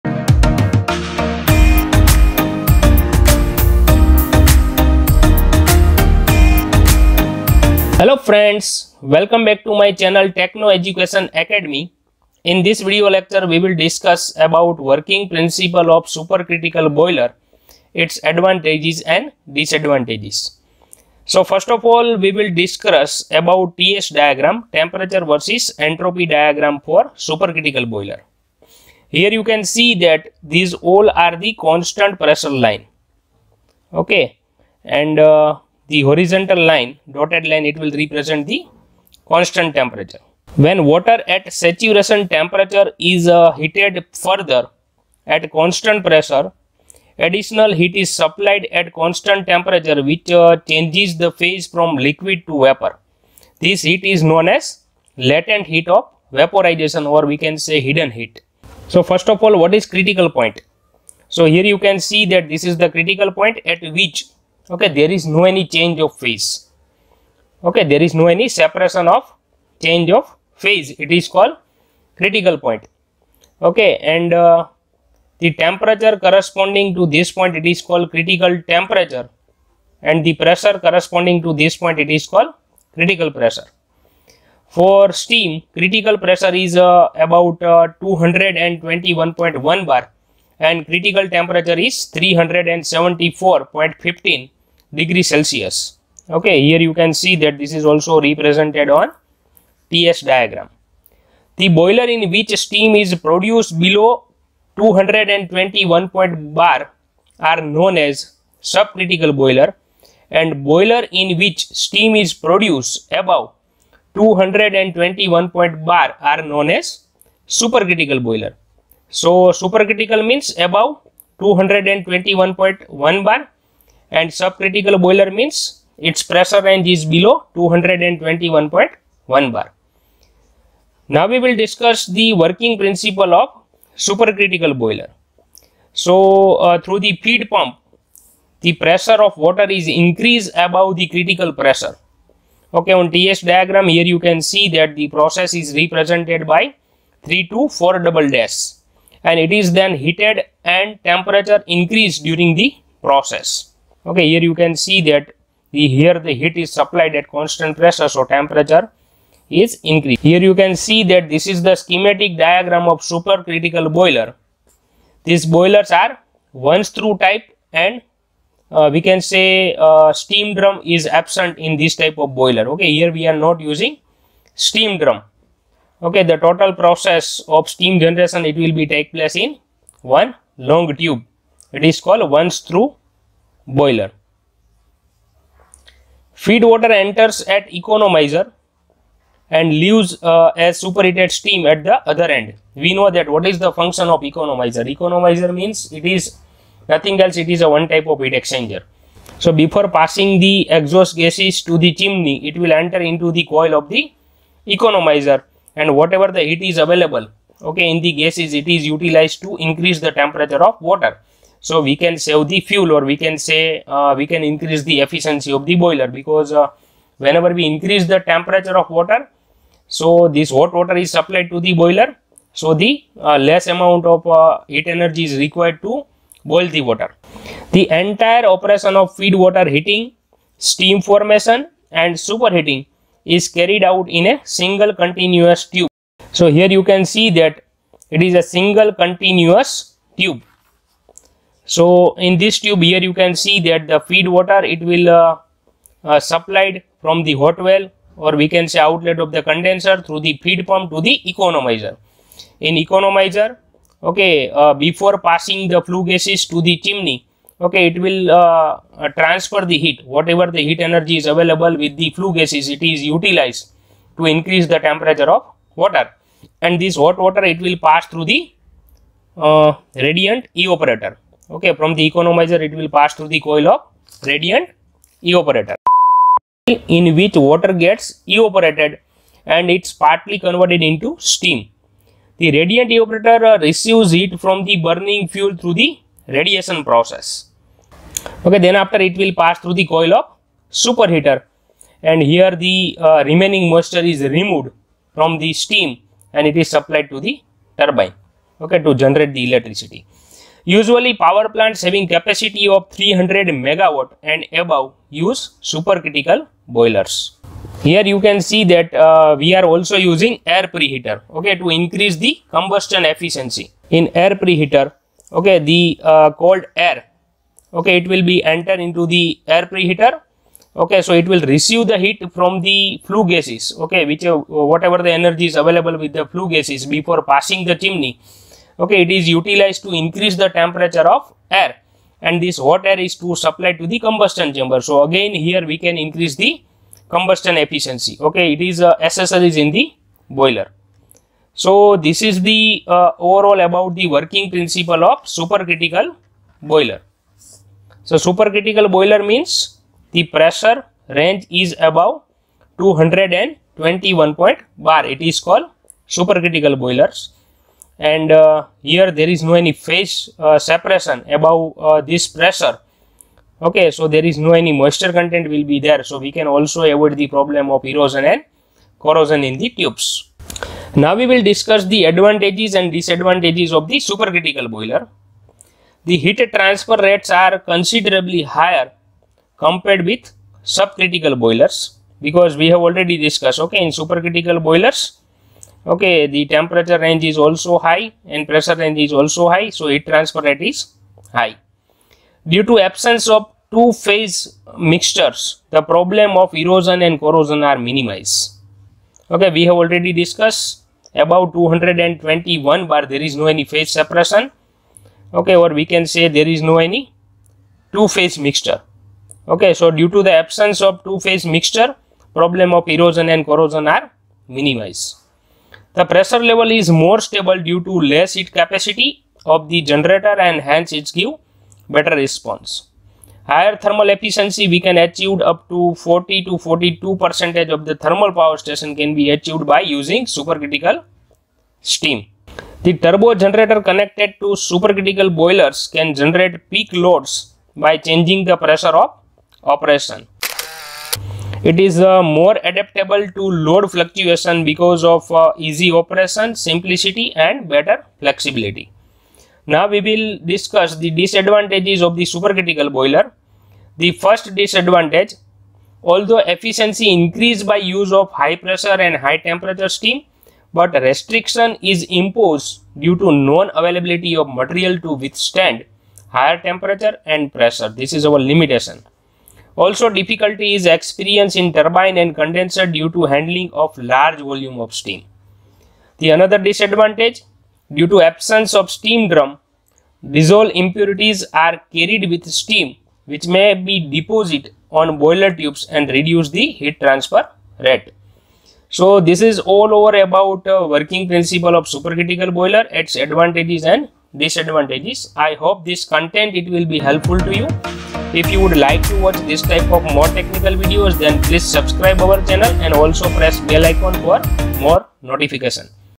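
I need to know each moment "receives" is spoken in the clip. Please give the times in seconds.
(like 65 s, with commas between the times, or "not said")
283 s, 321 s.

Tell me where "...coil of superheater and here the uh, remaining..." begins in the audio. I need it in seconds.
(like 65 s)
289 s.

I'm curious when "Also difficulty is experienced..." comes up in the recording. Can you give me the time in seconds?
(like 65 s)
469 s.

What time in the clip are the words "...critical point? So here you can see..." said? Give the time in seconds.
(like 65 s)
59 s.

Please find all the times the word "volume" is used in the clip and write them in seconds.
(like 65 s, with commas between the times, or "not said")
474 s.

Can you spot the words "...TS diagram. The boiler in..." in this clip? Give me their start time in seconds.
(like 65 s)
99 s.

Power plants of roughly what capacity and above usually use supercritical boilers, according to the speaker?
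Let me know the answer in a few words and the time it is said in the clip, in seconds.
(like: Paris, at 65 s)
300 megawatt, at 303 s.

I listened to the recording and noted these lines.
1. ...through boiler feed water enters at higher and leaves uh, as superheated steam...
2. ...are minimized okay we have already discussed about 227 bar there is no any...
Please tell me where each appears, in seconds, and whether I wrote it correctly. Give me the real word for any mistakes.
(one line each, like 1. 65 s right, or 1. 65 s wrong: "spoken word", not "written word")
1. 182 s wrong: "economizer", not "higher"
2. 397 s wrong: "221", not "227".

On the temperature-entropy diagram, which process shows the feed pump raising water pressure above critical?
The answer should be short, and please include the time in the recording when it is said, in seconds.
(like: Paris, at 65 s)
3 to 4 double dash, at 147 s.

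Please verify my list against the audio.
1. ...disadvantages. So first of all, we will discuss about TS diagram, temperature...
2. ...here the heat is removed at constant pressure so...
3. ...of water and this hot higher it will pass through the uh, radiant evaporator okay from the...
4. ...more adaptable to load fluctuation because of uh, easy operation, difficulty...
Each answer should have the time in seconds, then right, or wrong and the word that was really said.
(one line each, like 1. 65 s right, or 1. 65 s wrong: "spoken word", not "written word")
1. 19 s right
2. 155 s wrong: "supplied", not "removed"
3. 265 s wrong: "water", not "higher"
4. 442 s wrong: "simplicity", not "difficulty".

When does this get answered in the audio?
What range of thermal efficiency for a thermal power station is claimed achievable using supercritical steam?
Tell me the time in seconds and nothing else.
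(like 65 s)
426 s.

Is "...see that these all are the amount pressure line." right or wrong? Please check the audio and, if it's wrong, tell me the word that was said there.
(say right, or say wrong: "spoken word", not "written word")
wrong: "constant", not "amount".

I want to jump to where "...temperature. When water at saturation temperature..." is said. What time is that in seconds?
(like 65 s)
39 s.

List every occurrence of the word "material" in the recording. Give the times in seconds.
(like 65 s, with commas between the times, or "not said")
464 s.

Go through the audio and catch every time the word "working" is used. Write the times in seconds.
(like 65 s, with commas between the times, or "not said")
14 s, 132 s, 344 s, 490 s.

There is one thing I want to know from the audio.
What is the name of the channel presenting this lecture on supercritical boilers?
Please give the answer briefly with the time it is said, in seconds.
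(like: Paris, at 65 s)
Techno Education Academy, at 10 s.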